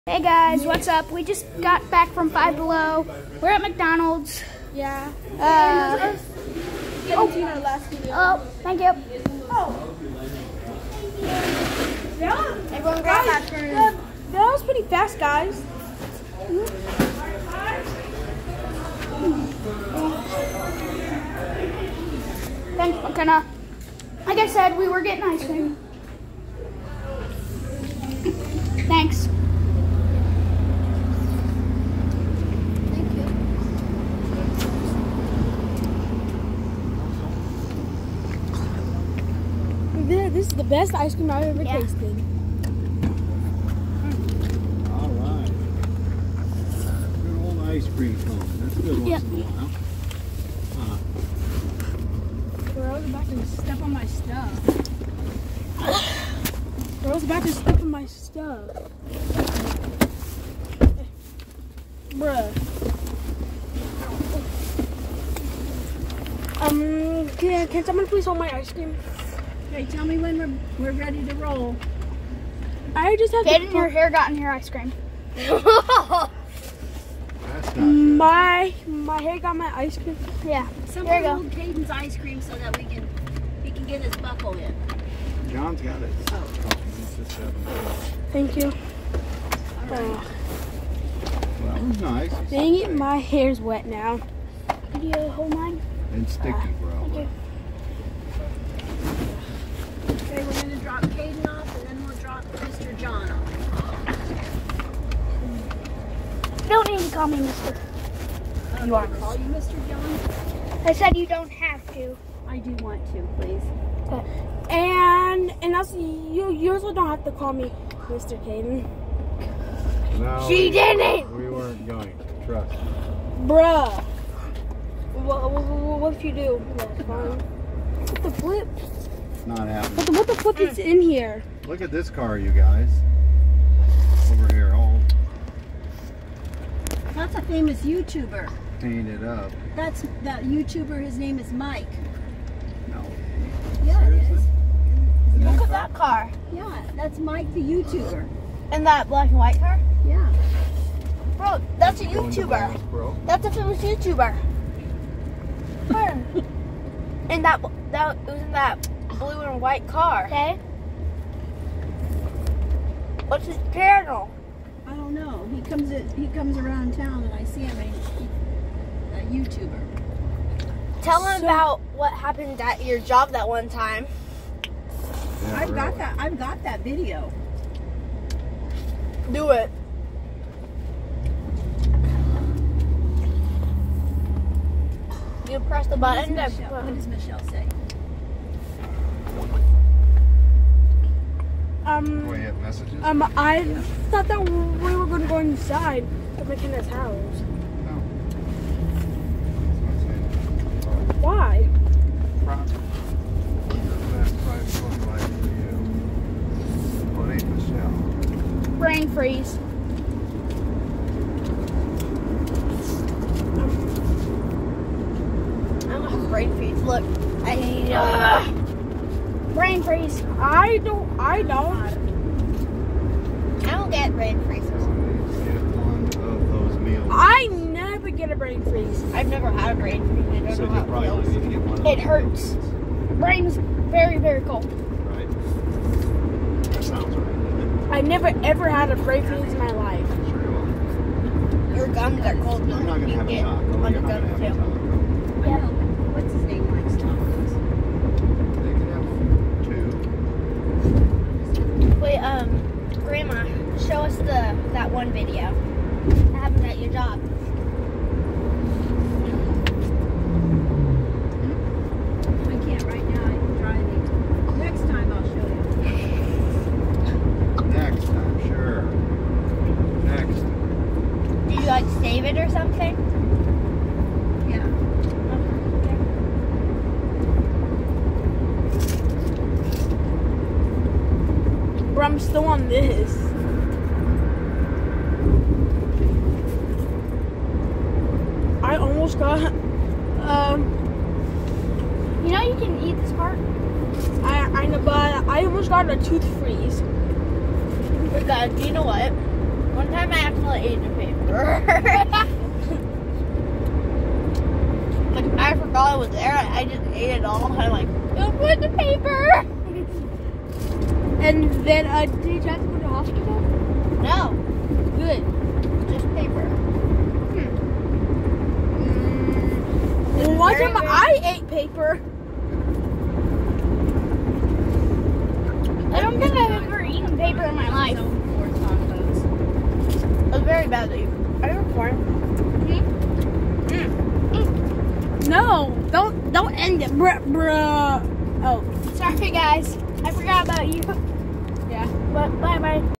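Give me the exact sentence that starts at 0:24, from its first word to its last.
Like I said, we were getting ice cream.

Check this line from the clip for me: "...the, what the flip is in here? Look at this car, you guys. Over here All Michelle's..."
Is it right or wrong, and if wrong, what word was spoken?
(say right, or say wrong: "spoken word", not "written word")
wrong: "That", not "Michelle".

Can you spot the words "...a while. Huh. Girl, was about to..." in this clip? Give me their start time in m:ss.
0:49.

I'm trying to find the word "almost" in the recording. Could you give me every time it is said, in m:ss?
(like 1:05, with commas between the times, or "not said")
4:48, 4:55.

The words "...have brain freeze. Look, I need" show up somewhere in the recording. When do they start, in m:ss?
3:36.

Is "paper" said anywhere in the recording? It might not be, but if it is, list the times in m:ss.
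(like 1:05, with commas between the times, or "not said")
5:00, 5:08, 5:16, 5:21.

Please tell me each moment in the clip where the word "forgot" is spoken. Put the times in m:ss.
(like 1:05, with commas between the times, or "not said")
5:05, 5:40.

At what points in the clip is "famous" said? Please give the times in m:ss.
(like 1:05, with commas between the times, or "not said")
2:17, 2:33.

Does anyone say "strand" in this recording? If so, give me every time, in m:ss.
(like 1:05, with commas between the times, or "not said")
not said.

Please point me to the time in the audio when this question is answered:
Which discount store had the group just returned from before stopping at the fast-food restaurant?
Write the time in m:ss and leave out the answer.
0:02.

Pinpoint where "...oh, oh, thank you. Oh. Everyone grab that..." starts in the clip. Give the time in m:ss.
0:07.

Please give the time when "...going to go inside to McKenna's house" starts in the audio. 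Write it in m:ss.
3:15.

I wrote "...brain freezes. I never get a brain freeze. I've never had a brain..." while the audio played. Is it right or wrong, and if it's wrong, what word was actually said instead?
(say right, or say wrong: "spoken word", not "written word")
right.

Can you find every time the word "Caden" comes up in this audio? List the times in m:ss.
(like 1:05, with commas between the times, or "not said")
1:21, 1:58.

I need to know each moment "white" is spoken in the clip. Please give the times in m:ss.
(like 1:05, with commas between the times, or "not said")
2:29, 2:39.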